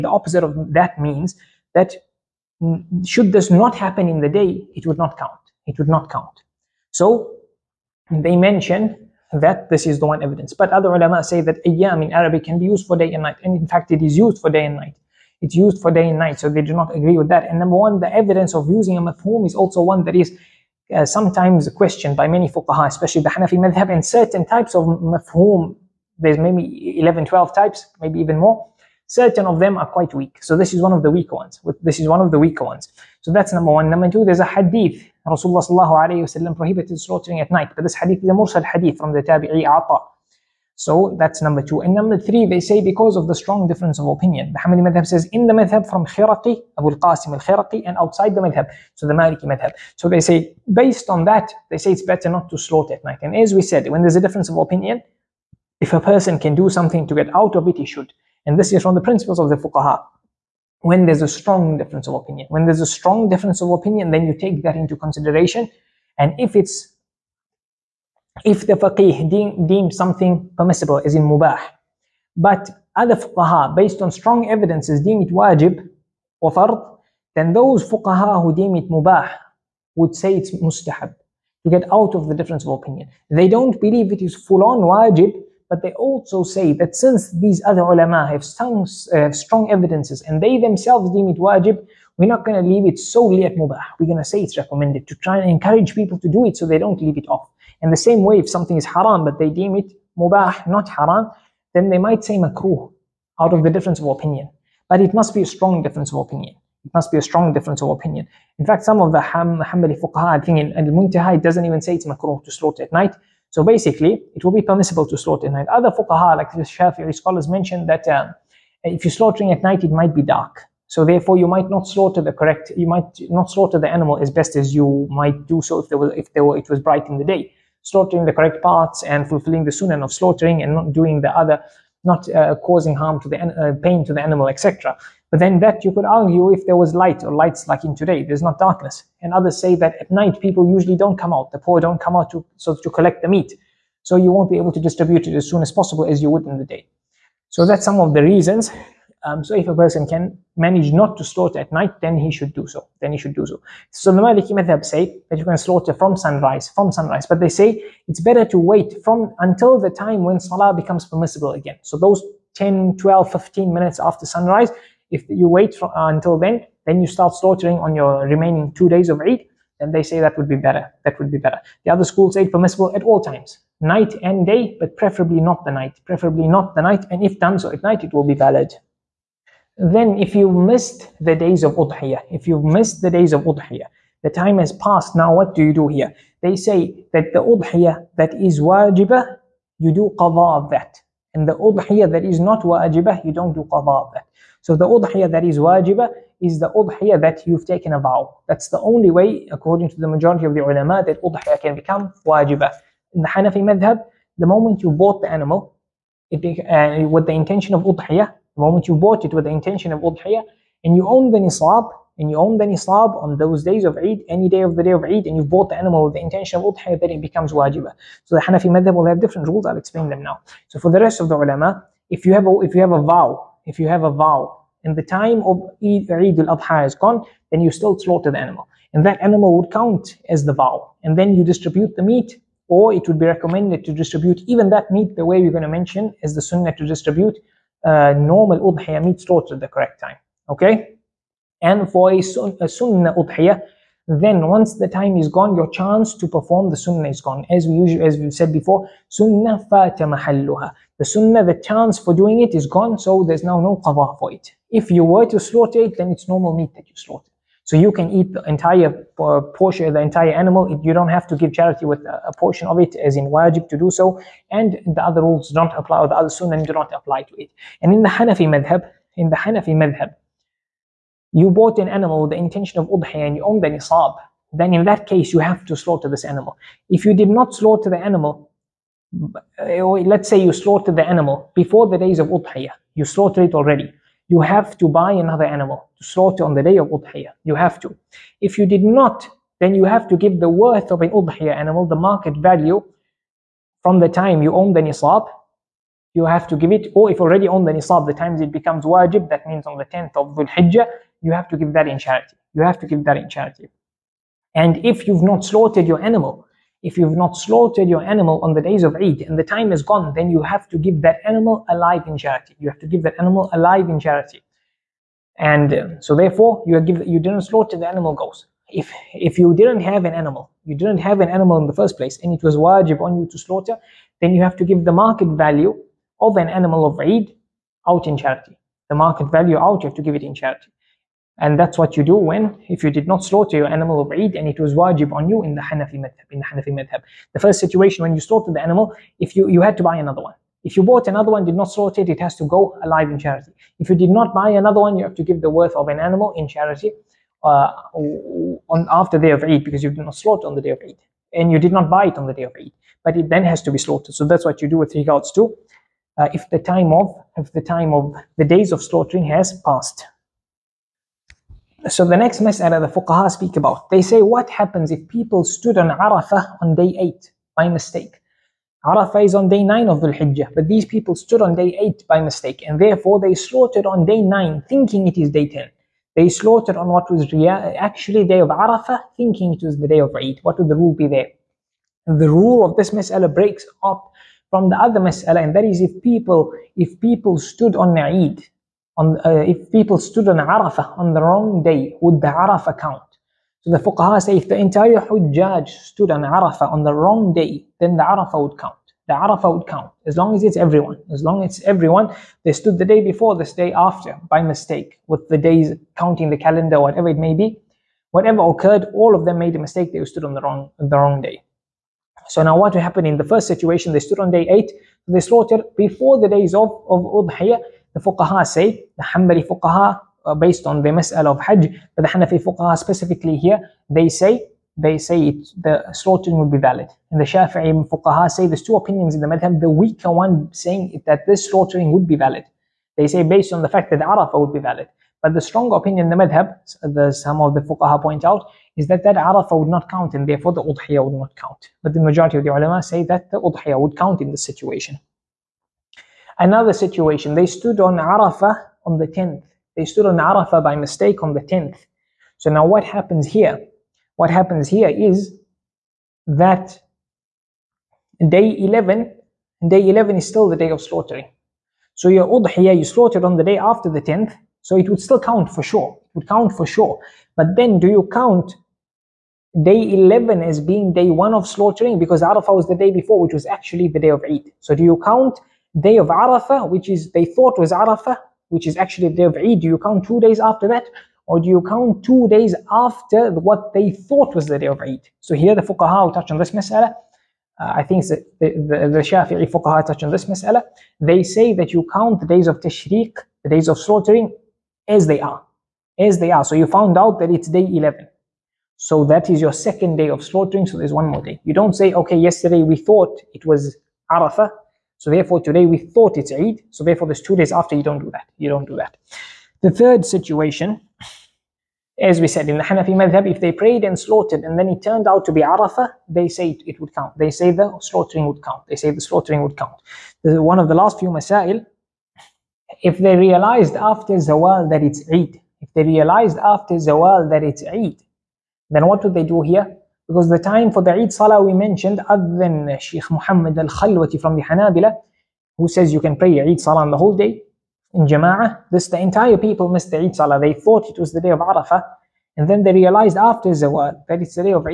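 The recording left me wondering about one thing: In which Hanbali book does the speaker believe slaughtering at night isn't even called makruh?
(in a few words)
Al-Muntaha.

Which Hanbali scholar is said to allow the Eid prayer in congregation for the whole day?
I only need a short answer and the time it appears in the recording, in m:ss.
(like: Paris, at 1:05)
Sheikh Muhammad Al Khalwati, at 8:52.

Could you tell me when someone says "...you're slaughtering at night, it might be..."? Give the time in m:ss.
1:59.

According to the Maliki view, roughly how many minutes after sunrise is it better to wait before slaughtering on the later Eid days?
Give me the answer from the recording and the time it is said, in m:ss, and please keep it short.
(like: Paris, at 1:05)
10, 12, 15 minutes, at 2:42.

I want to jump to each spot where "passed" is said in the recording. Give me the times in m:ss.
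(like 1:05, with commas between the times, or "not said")
3:04, 5:59.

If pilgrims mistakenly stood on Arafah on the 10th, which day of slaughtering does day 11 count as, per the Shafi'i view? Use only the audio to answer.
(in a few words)
Second day.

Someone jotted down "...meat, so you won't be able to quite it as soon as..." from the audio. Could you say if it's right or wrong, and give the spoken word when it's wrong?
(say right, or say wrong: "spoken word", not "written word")
wrong: "distribute", not "quite".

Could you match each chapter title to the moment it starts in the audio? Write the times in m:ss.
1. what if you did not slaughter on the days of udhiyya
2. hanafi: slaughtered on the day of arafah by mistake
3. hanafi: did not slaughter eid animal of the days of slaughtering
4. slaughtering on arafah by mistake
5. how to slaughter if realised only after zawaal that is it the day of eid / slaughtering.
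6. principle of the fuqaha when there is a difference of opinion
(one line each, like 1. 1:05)
1. 2:58
2. 8:28
3. 4:27
4. 5:59
5. 8:41
6. 0:49.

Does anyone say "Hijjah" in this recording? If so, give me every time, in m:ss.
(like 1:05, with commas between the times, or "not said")
5:00, 6:10.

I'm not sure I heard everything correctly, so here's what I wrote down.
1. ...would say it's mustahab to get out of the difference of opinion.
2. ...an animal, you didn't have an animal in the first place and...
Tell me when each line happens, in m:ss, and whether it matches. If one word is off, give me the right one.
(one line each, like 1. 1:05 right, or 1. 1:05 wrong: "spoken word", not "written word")
1. 1:19 right
2. 5:20 right.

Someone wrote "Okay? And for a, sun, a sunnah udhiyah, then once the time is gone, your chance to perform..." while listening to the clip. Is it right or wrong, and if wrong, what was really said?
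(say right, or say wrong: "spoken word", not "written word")
right.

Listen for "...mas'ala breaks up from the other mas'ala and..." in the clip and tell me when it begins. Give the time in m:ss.
6:22.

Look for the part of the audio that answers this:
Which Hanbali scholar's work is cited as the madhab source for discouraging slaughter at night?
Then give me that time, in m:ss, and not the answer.
0:46.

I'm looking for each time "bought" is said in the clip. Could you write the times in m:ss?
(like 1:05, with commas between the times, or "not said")
3:24, 3:28, 3:35, 4:31, 5:40.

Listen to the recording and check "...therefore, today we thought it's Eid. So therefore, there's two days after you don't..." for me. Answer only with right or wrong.
right.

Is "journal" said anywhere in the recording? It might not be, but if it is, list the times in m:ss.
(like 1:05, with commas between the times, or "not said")
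not said.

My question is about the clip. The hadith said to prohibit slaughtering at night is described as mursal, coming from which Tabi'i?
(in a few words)
Ata.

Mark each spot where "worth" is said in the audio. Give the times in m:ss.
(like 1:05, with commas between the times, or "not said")
4:50, 5:45.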